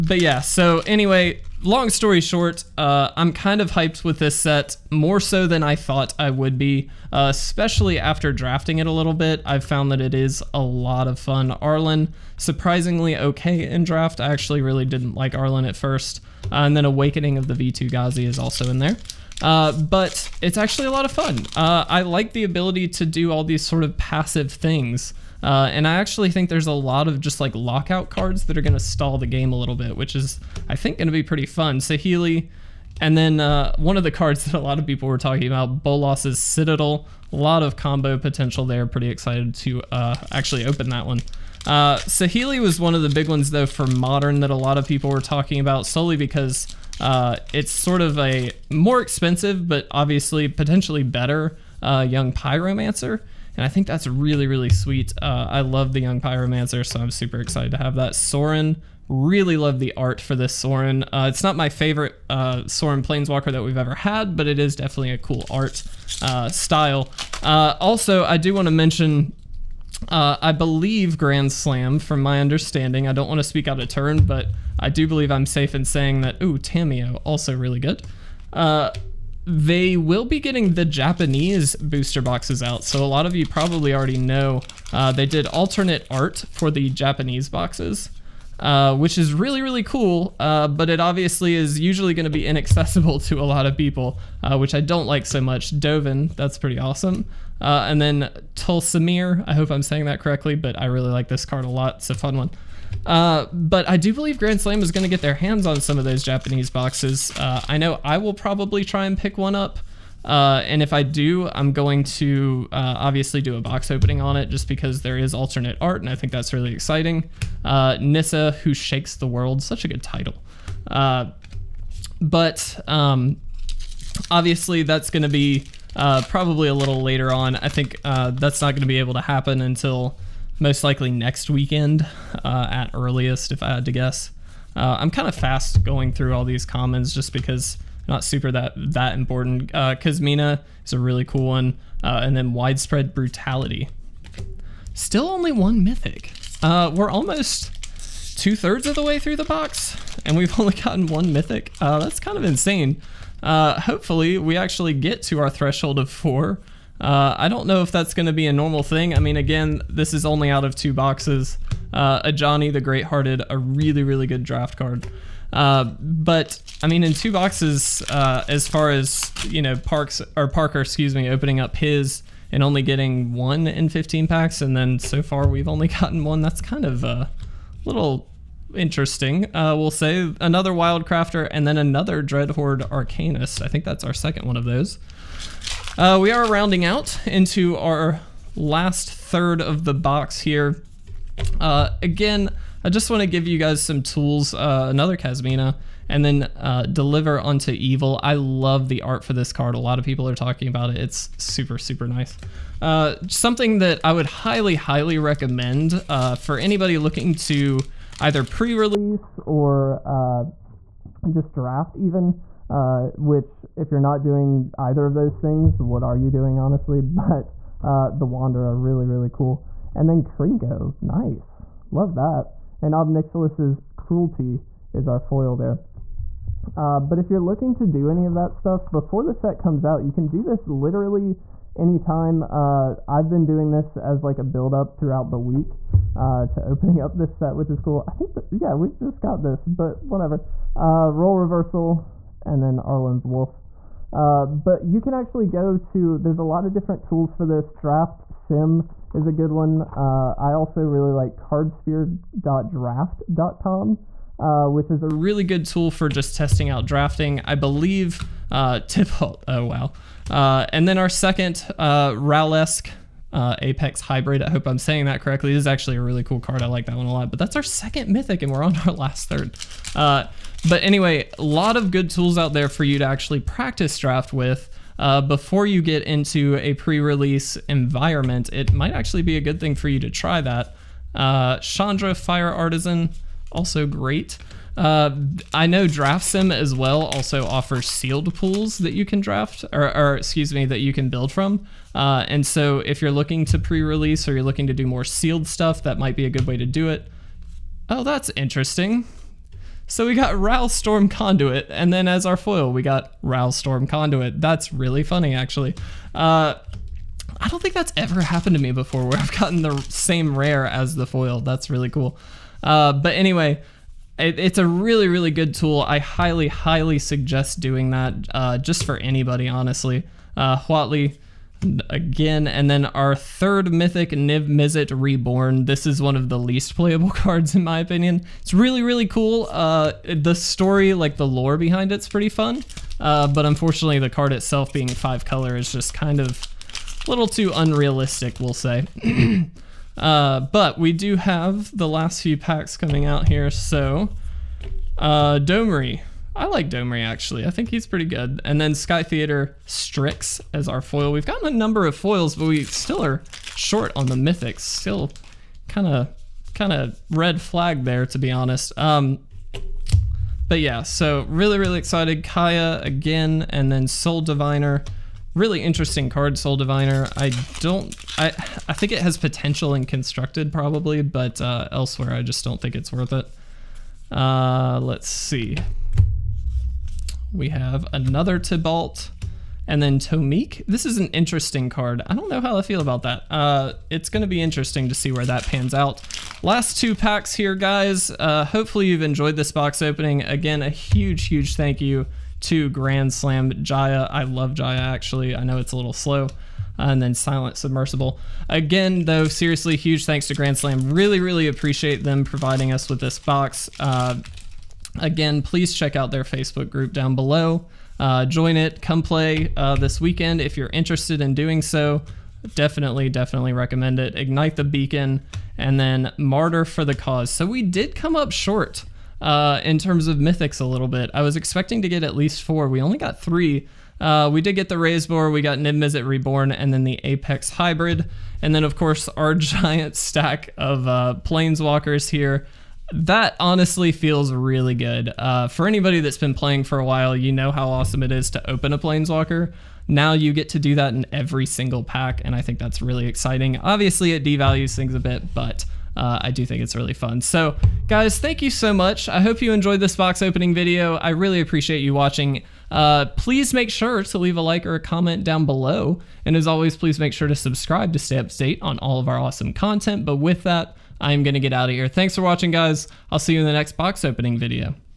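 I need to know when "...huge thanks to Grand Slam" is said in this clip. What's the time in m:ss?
6:39.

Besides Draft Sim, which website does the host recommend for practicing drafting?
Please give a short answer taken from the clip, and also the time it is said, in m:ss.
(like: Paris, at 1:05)
cardsphere.draft.com, at 4:11.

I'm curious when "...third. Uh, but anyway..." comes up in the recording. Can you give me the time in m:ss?
4:29.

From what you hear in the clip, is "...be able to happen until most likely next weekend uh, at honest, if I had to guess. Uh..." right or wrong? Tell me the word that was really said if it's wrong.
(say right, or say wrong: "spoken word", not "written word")
wrong: "earliest", not "honest".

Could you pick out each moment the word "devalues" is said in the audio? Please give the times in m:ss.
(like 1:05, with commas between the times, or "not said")
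7:24.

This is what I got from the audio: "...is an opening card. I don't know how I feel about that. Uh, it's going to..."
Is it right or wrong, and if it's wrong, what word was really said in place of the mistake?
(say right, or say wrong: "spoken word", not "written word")
wrong: "interesting", not "opening".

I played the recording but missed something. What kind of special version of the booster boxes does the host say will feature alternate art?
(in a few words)
Japanese booster boxes.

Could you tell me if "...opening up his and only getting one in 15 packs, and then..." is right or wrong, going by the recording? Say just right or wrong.
right.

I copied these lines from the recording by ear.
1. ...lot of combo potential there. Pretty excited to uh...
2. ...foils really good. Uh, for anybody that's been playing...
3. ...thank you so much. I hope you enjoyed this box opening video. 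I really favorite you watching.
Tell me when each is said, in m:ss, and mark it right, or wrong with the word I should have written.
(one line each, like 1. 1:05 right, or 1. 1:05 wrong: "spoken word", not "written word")
1. 0:37 right
2. 7:13 wrong: "feels", not "foils"
3. 7:28 wrong: "appreciate", not "favorite".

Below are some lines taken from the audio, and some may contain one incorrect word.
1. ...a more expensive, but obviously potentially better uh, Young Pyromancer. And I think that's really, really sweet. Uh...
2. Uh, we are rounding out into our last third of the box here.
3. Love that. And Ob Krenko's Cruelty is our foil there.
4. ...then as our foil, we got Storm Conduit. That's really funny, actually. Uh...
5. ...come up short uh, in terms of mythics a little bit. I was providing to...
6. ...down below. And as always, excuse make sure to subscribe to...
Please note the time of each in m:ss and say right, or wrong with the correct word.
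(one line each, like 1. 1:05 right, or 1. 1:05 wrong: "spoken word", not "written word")
1. 0:48 right
2. 3:05 right
3. 3:41 wrong: "Nixilis", not "Krenko"
4. 5:01 right
5. 6:57 wrong: "expecting", not "providing"
6. 7:35 wrong: "please", not "excuse".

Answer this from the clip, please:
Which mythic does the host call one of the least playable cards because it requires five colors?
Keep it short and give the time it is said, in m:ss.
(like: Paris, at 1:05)
Niv Mizzet Reborn, at 5:24.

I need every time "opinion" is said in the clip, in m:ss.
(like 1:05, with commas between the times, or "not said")
5:27.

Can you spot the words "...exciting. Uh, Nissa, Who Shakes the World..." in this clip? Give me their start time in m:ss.
1:56.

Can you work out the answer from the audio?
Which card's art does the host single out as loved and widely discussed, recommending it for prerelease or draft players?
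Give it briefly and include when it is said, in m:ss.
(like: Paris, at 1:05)
Deliver Unto Evil, at 3:16.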